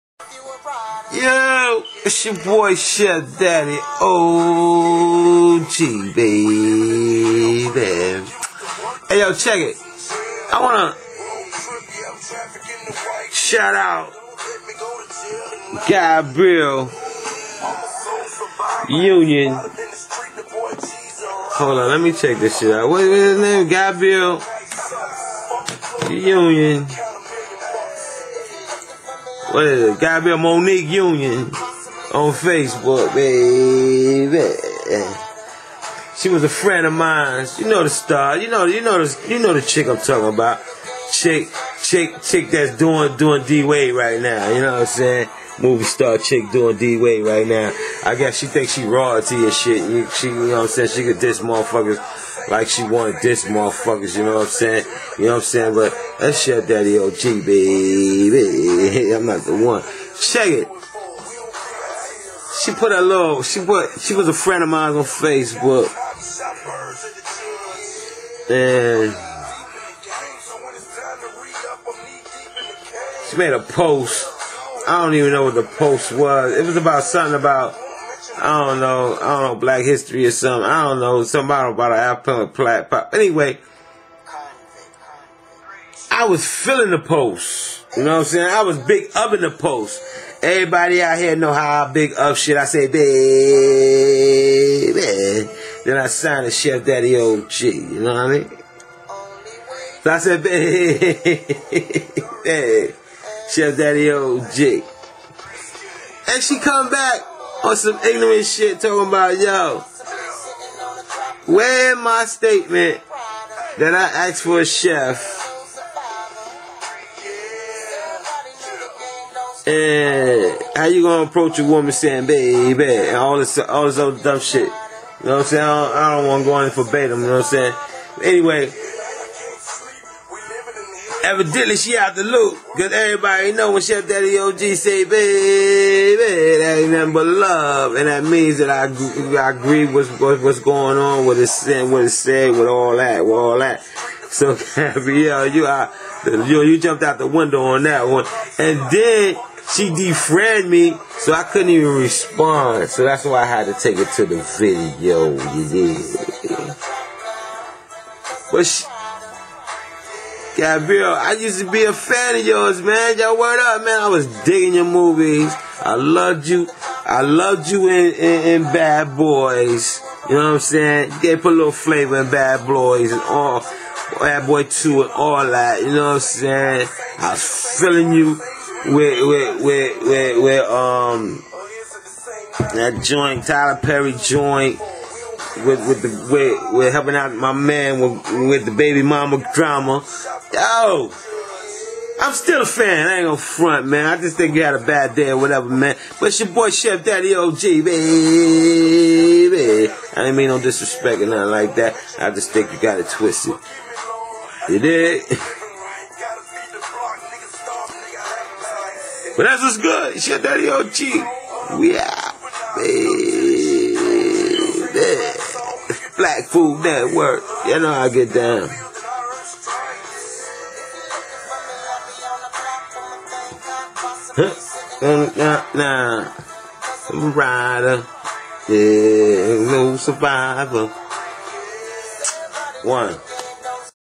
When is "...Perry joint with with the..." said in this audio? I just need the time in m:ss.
3:03.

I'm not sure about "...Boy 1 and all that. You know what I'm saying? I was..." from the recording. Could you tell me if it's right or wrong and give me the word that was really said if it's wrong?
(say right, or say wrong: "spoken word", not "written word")
wrong: "2", not "1".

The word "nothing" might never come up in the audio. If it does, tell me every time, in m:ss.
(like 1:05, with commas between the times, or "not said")
2:16, 3:21.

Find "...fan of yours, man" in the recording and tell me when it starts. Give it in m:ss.
2:41.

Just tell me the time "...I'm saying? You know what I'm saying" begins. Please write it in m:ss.
0:54.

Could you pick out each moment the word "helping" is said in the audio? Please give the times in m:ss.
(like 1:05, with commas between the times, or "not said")
3:06.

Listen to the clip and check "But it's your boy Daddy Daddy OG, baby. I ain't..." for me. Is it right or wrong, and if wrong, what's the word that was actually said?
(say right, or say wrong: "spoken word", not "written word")
wrong: "Chef", not "Daddy".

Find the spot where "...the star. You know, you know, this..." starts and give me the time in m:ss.
0:37.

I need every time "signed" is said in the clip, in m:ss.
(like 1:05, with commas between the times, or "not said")
1:36.